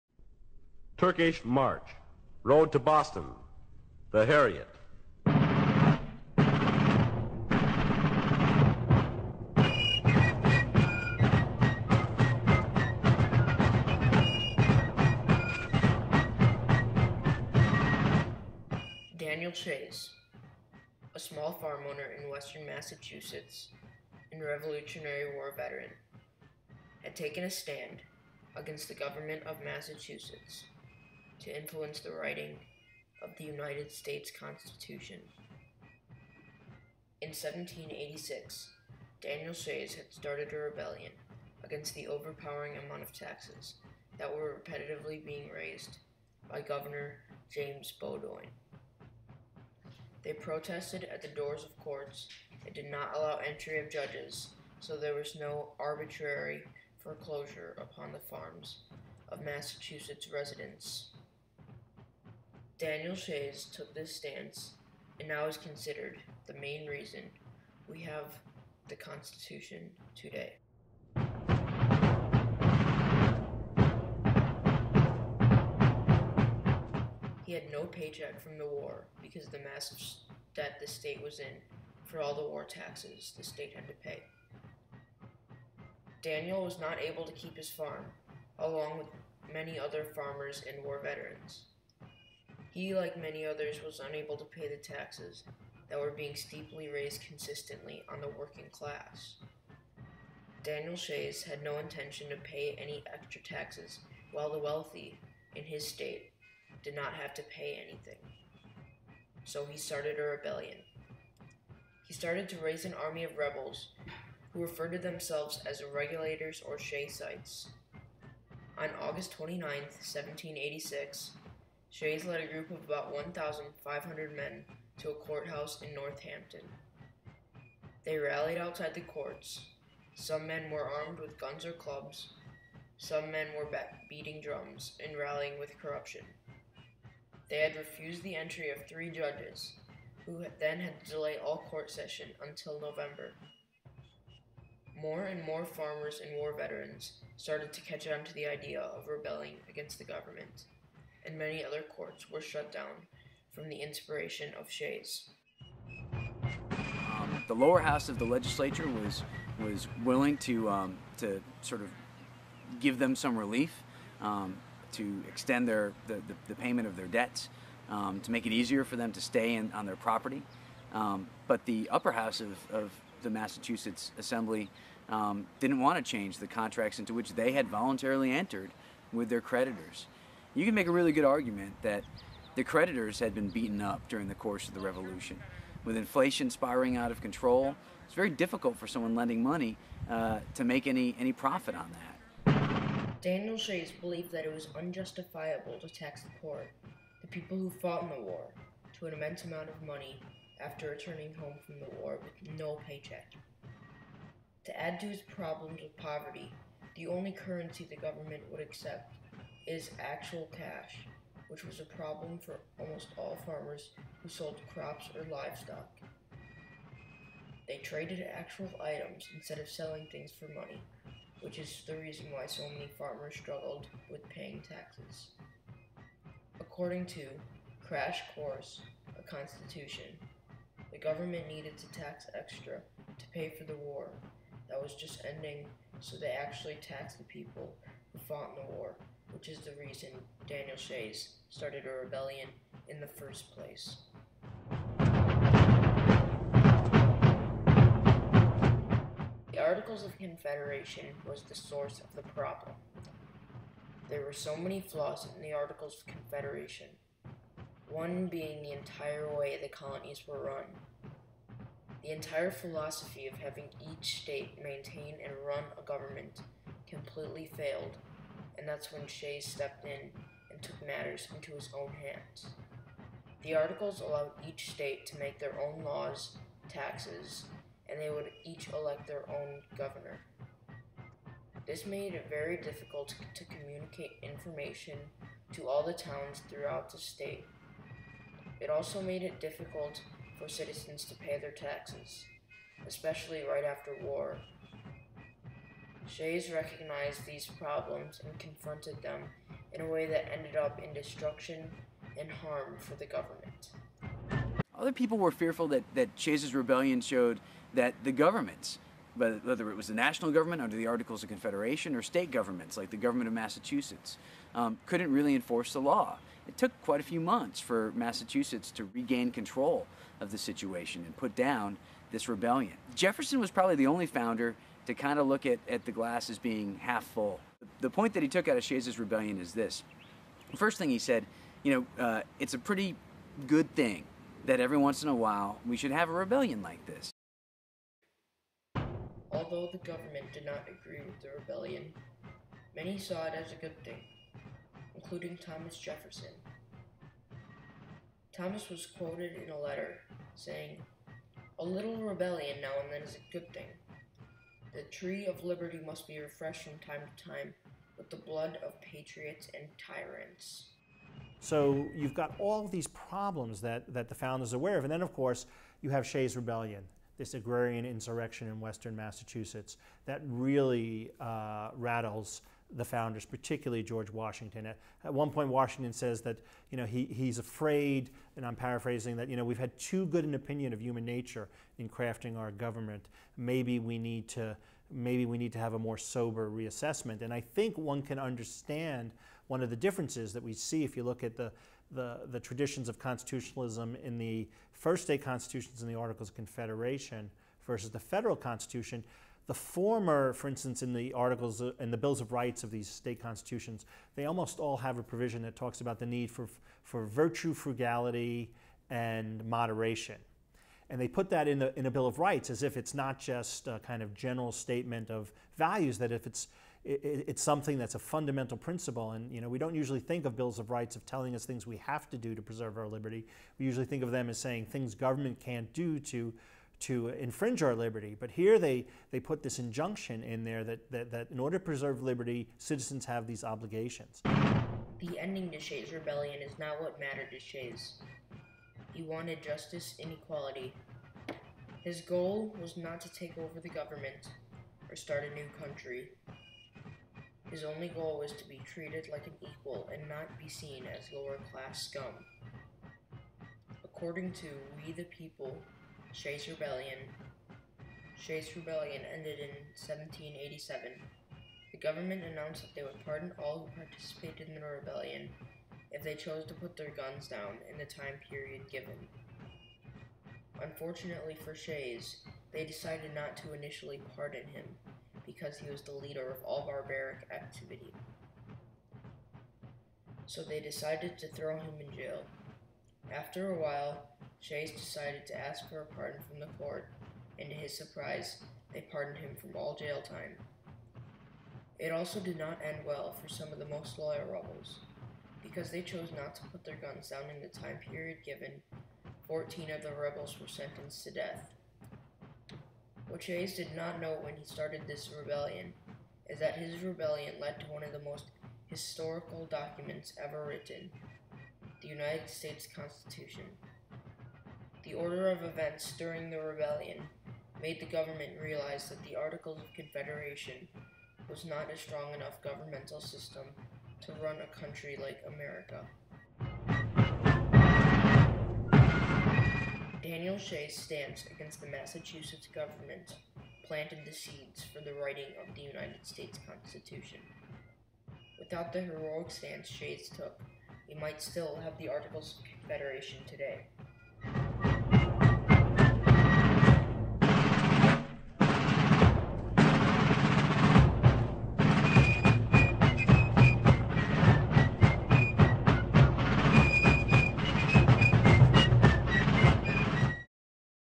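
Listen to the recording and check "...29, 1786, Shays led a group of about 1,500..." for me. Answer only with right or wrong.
right.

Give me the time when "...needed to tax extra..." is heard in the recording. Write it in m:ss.
3:51.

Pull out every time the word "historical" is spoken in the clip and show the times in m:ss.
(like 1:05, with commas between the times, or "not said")
8:28.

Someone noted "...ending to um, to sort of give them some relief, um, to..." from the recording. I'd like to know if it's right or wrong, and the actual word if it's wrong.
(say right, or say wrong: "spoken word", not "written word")
wrong: "willing", not "ending".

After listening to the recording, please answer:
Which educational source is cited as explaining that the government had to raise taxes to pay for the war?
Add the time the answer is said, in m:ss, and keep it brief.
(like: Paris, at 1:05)
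Crash Course, at 3:47.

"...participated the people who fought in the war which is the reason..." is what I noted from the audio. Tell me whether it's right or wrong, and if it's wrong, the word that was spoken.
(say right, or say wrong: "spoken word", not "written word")
wrong: "taxed", not "participated".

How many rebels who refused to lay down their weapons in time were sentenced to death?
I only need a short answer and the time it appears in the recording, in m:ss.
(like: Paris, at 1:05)
14, at 8:19.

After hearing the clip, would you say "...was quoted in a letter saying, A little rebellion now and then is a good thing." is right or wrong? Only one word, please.
right.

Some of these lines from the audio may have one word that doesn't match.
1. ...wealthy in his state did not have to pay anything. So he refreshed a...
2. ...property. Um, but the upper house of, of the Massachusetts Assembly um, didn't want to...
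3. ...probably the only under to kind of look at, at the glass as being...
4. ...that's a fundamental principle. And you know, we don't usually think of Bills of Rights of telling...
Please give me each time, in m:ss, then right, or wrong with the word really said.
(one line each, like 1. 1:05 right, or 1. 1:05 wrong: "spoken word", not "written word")
1. 1:44 wrong: "started", not "refreshed"
2. 2:49 right
3. 5:23 wrong: "founder", not "under"
4. 6:57 right.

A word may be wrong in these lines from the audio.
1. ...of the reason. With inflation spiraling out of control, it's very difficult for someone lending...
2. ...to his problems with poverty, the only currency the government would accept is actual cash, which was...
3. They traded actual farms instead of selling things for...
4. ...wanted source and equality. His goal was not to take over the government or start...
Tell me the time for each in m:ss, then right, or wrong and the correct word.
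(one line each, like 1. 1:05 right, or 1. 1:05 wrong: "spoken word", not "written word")
1. 3:04 wrong: "revolution", not "reason"
2. 3:24 right
3. 3:37 wrong: "items", not "farms"
4. 7:19 wrong: "justice", not "source".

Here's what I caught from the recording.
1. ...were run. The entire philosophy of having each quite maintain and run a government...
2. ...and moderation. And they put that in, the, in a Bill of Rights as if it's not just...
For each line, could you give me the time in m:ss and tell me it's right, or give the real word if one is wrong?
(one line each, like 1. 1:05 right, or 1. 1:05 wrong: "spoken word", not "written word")
1. 4:20 wrong: "state", not "quite"
2. 6:48 right.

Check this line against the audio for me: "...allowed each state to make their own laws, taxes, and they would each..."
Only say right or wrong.
right.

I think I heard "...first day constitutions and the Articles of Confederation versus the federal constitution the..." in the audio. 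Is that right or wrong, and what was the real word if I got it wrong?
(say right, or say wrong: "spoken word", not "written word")
right.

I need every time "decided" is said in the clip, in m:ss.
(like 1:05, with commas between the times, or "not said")
7:52, 8:00, 8:04.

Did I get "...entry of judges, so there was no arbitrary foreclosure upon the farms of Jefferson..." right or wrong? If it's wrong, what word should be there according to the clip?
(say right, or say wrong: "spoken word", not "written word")
wrong: "Massachusetts", not "Jefferson".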